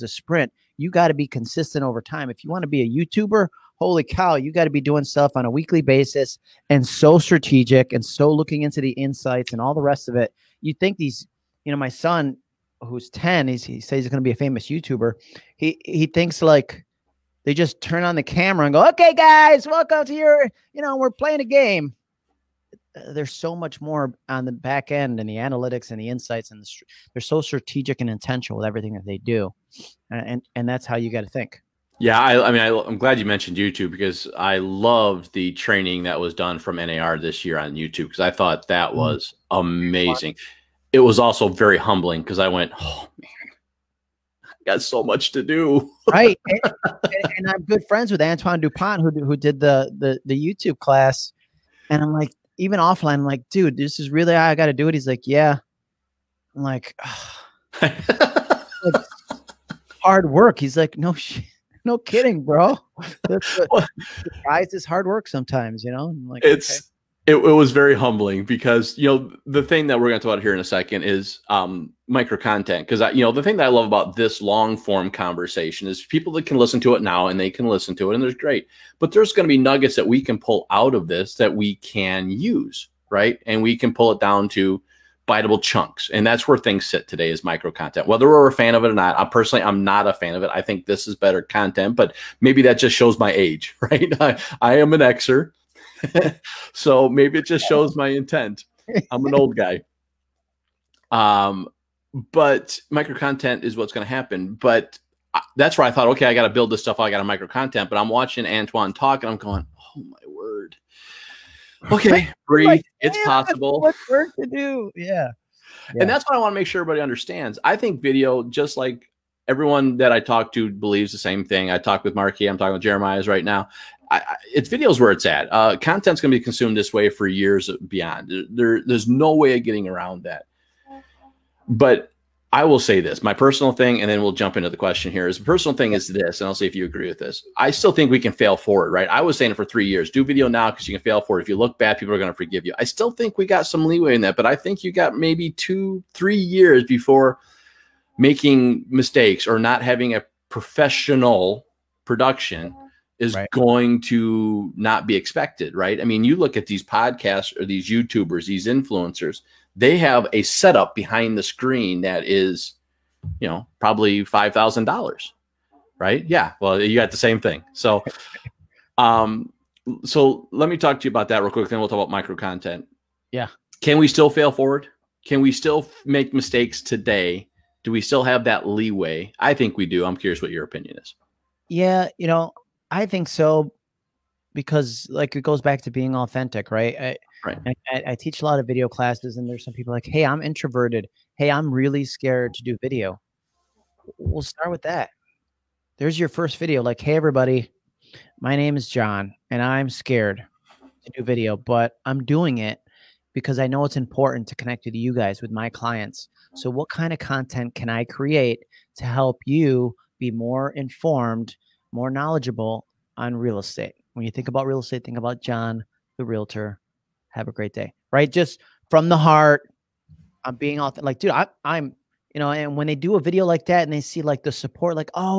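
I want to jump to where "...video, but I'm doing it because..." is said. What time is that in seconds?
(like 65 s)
201 s.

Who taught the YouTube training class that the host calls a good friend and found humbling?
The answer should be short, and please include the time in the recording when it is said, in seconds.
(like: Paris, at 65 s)
Antoine Dupont, at 48 s.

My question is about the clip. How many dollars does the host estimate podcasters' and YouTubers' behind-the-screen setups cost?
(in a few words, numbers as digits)
$5,000.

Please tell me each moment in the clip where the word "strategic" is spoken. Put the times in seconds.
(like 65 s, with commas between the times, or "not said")
7 s, 27 s.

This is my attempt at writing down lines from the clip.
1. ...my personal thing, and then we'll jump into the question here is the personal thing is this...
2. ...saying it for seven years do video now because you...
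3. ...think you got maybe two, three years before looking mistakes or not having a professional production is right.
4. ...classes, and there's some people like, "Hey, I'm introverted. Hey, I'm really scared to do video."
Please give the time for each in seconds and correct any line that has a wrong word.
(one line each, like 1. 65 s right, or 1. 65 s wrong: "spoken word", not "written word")
1. 133 s right
2. 139 s wrong: "three", not "seven"
3. 144 s wrong: "making", not "looking"
4. 188 s right.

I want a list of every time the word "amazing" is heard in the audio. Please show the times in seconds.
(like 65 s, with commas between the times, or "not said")
39 s.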